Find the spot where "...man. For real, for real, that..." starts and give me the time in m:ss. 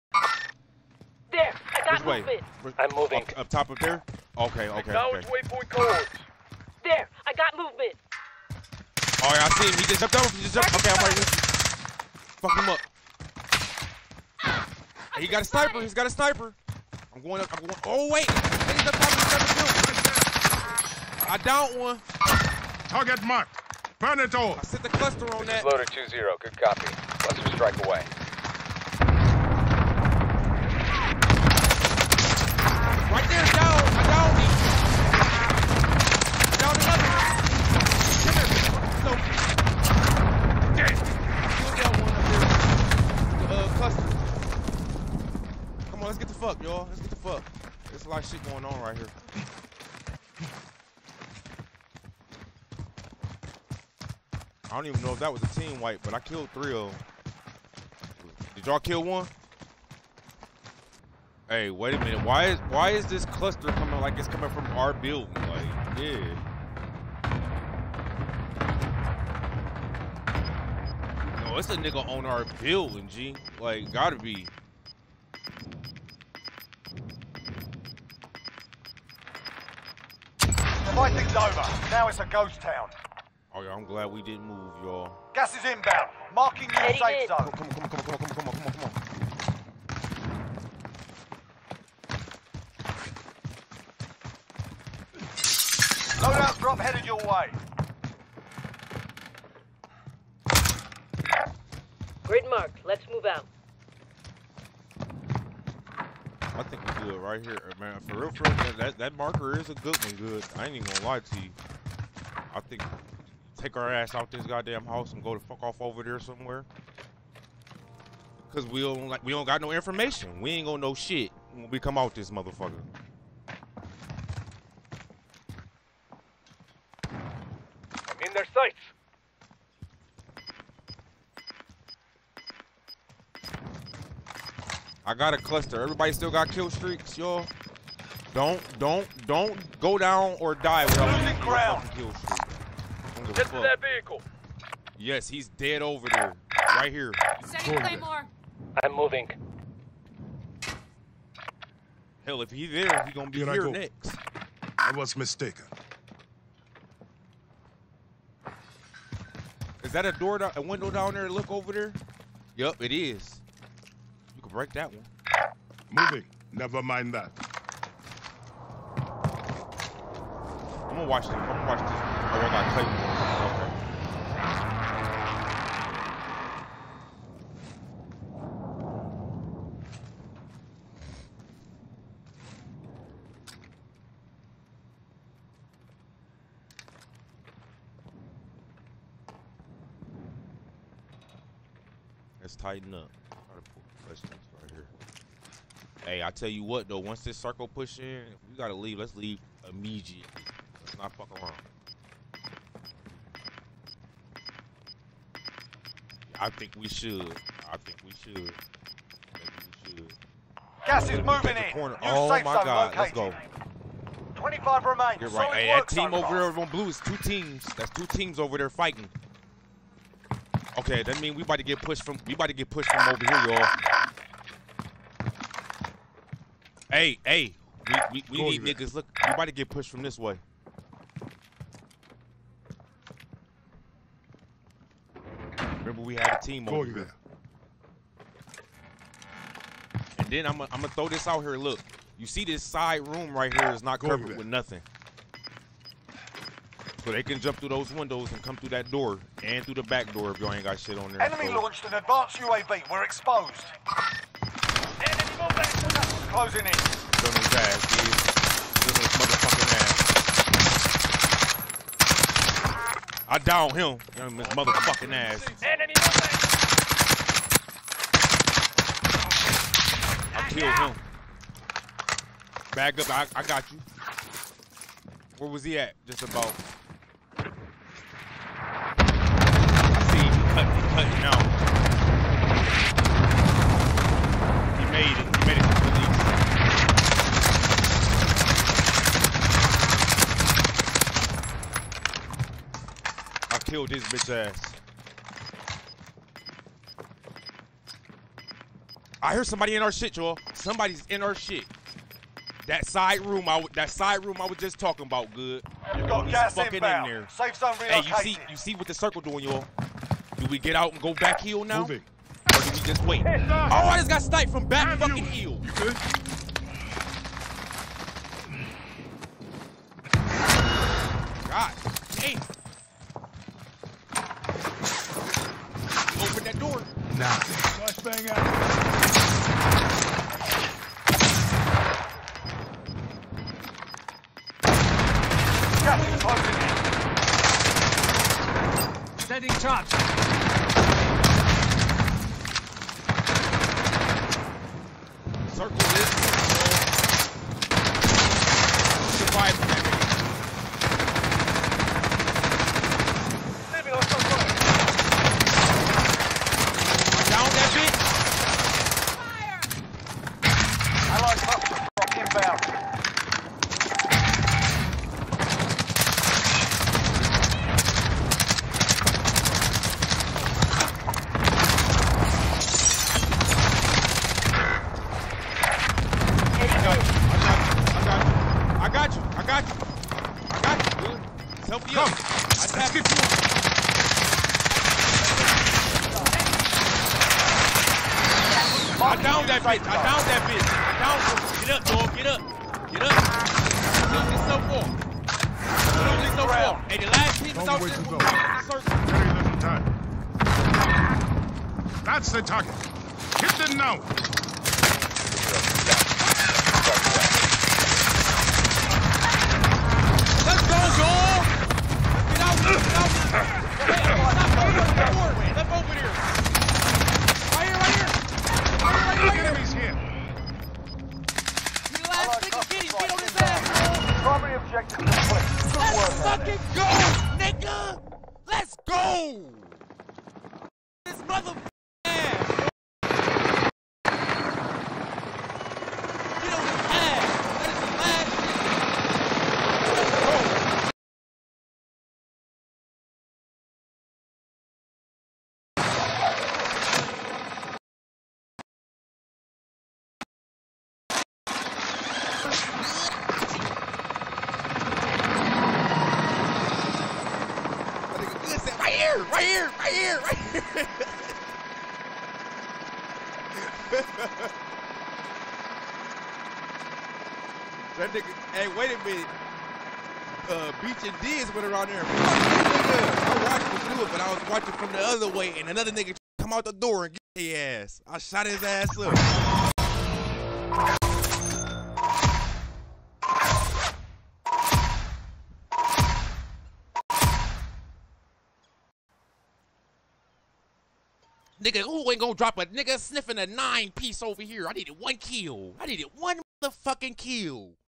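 1:47.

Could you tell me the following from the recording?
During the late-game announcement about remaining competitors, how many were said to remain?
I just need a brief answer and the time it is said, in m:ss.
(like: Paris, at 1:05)
25, at 3:34.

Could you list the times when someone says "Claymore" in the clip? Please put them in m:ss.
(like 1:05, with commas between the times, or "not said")
2:27, 2:52.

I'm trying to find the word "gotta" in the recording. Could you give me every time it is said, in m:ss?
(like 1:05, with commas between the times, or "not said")
1:13, 3:18.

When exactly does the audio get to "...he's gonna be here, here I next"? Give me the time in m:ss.
2:33.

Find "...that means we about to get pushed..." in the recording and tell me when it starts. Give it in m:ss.
3:41.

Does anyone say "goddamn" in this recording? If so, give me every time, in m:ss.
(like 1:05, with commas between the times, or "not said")
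1:54.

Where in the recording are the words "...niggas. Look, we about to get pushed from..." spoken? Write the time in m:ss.
3:48.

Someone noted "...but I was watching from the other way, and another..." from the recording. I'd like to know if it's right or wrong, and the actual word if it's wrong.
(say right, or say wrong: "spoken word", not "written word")
right.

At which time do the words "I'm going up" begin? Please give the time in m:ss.
0:17.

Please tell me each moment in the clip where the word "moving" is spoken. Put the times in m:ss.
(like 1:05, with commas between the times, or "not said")
0:02, 2:28, 2:45, 3:31, 5:11.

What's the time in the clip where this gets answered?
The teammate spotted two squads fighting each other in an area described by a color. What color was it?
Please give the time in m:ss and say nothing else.
3:35.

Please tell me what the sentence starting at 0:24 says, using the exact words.
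I set the cluster on this that.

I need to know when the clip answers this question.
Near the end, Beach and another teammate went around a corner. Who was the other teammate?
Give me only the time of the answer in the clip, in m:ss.
7:50.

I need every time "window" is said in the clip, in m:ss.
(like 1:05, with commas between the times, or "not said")
2:40, 4:07.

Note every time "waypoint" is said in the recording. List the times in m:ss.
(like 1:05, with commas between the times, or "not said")
0:05.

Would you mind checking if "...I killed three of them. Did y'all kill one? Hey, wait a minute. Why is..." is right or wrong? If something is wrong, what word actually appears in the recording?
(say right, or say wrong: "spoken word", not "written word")
right.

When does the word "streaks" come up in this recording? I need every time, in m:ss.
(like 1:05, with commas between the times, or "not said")
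2:16, 2:22.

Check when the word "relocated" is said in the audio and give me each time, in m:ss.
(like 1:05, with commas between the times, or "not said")
5:07.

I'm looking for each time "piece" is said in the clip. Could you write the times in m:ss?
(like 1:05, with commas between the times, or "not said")
6:37, 8:13.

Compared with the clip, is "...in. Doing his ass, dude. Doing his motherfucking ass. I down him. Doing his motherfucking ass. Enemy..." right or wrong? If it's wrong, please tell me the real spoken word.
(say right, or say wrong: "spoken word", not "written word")
right.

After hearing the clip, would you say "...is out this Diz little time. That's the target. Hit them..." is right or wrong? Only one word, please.
wrong.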